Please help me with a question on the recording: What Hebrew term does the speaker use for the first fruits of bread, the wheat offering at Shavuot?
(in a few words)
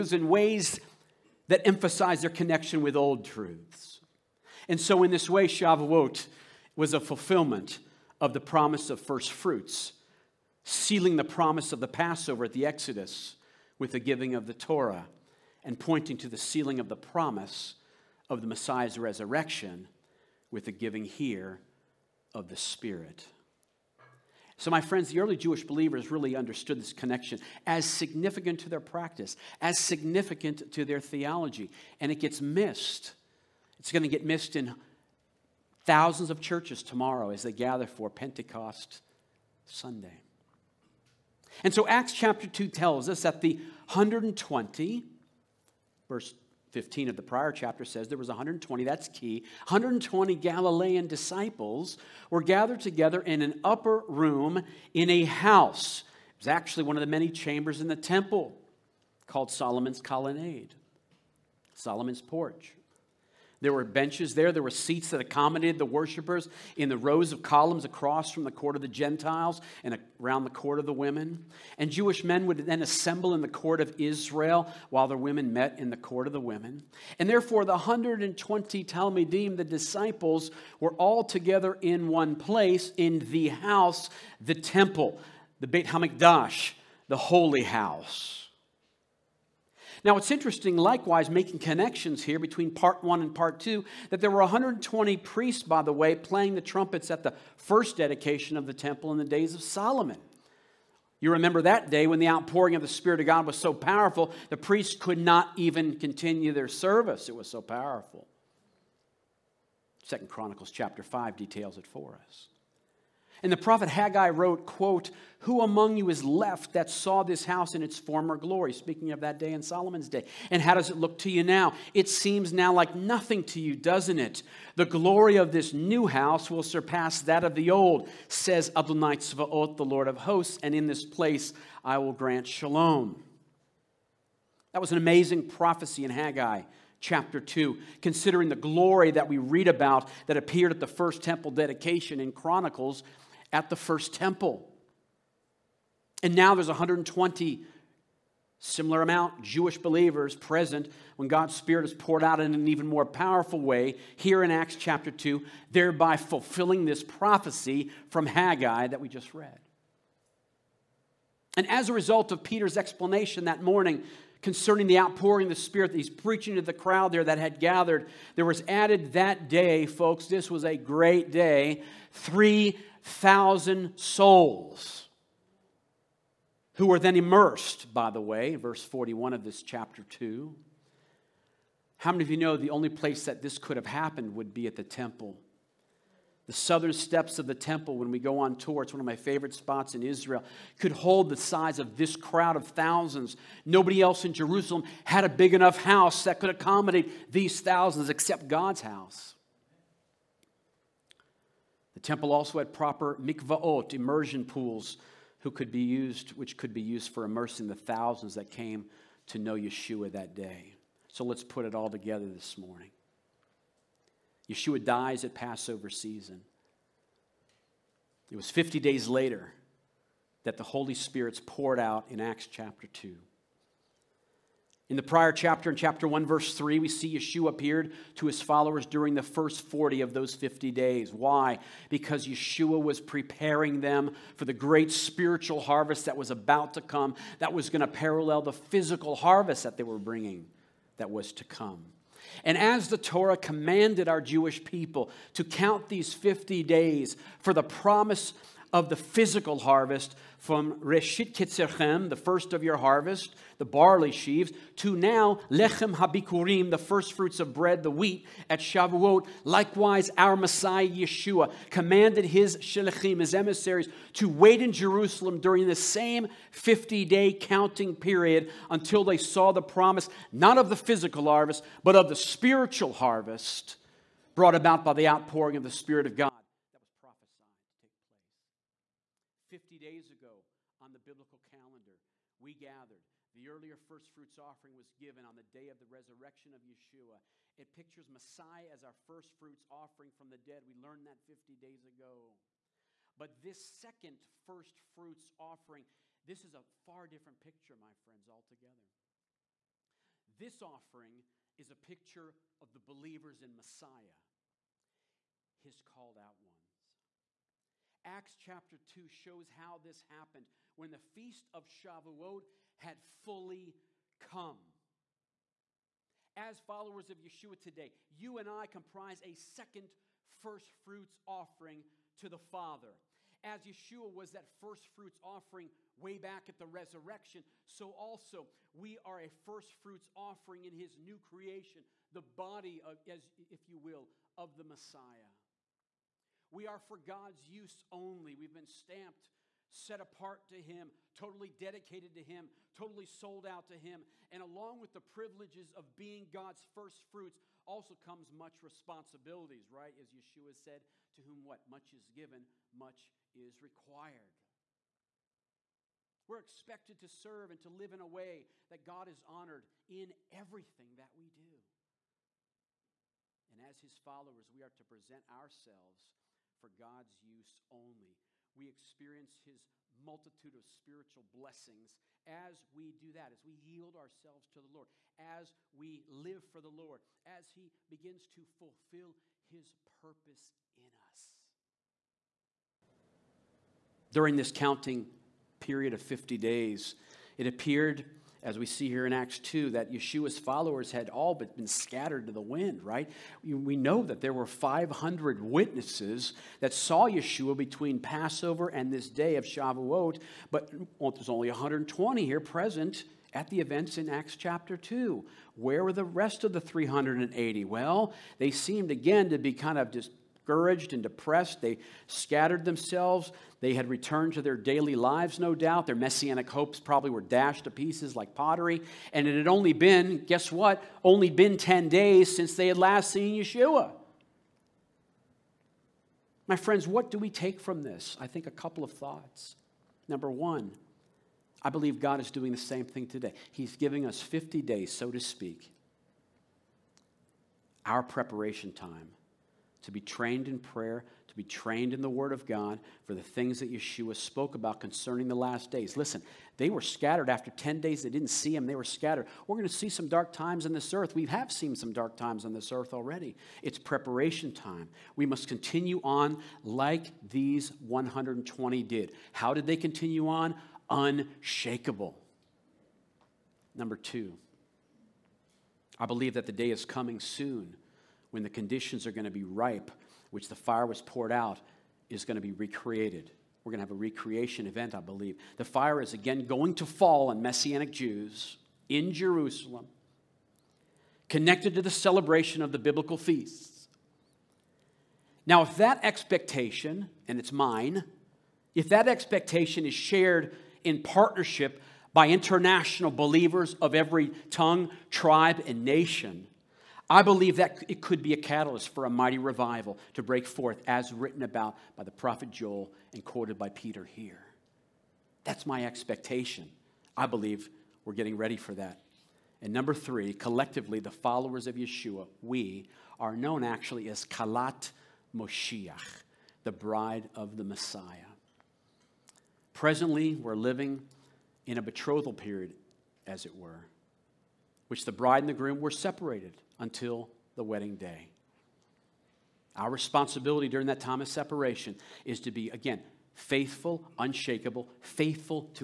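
Lechem Habikurim.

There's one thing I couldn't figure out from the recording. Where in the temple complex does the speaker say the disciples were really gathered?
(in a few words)
Solomon's colonnade.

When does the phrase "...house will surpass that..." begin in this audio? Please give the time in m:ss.
2:06.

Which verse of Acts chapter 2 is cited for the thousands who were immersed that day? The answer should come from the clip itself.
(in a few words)
verse 41.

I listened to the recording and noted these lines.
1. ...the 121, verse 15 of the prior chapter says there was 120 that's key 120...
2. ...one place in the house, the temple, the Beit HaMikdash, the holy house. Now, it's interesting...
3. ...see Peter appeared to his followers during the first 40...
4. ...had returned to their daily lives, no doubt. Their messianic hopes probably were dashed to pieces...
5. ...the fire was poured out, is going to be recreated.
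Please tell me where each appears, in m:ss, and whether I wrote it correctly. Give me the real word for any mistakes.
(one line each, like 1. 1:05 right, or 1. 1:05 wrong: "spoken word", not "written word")
1. 0:43 wrong: "120", not "121"
2. 1:22 right
3. 3:46 wrong: "Yeshua", not "Peter"
4. 6:53 right
5. 7:50 right.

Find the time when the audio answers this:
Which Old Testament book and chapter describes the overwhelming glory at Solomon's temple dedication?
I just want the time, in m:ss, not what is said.
1:50.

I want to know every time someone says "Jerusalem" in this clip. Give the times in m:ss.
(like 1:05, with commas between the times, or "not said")
3:14, 4:24, 7:59.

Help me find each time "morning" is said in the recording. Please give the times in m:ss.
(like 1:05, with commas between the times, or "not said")
2:43, 3:32.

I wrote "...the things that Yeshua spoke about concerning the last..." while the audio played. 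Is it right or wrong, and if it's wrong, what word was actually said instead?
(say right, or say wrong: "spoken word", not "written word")
right.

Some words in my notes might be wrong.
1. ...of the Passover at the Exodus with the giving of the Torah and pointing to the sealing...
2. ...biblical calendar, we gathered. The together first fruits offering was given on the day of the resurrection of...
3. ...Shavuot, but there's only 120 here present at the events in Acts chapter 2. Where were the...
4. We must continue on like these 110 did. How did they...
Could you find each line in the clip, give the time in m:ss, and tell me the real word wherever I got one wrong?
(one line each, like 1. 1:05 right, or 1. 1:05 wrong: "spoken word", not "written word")
1. 0:11 right
2. 4:40 wrong: "earlier", not "together"
3. 6:39 right
4. 7:35 wrong: "120", not "110".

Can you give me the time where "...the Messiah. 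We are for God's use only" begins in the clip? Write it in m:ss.
5:34.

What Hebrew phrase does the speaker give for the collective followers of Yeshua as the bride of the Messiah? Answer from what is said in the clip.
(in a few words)
Kalat Moshiach.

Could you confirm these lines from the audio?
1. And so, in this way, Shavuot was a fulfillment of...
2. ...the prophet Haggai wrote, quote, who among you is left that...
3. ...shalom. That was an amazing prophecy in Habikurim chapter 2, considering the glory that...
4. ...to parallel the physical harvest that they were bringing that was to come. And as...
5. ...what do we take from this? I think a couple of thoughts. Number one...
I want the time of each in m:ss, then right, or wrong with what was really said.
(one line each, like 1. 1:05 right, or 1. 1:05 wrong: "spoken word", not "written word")
1. 0:04 right
2. 1:53 right
3. 2:12 wrong: "Haggai", not "Habikurim"
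4. 3:57 right
5. 7:06 right.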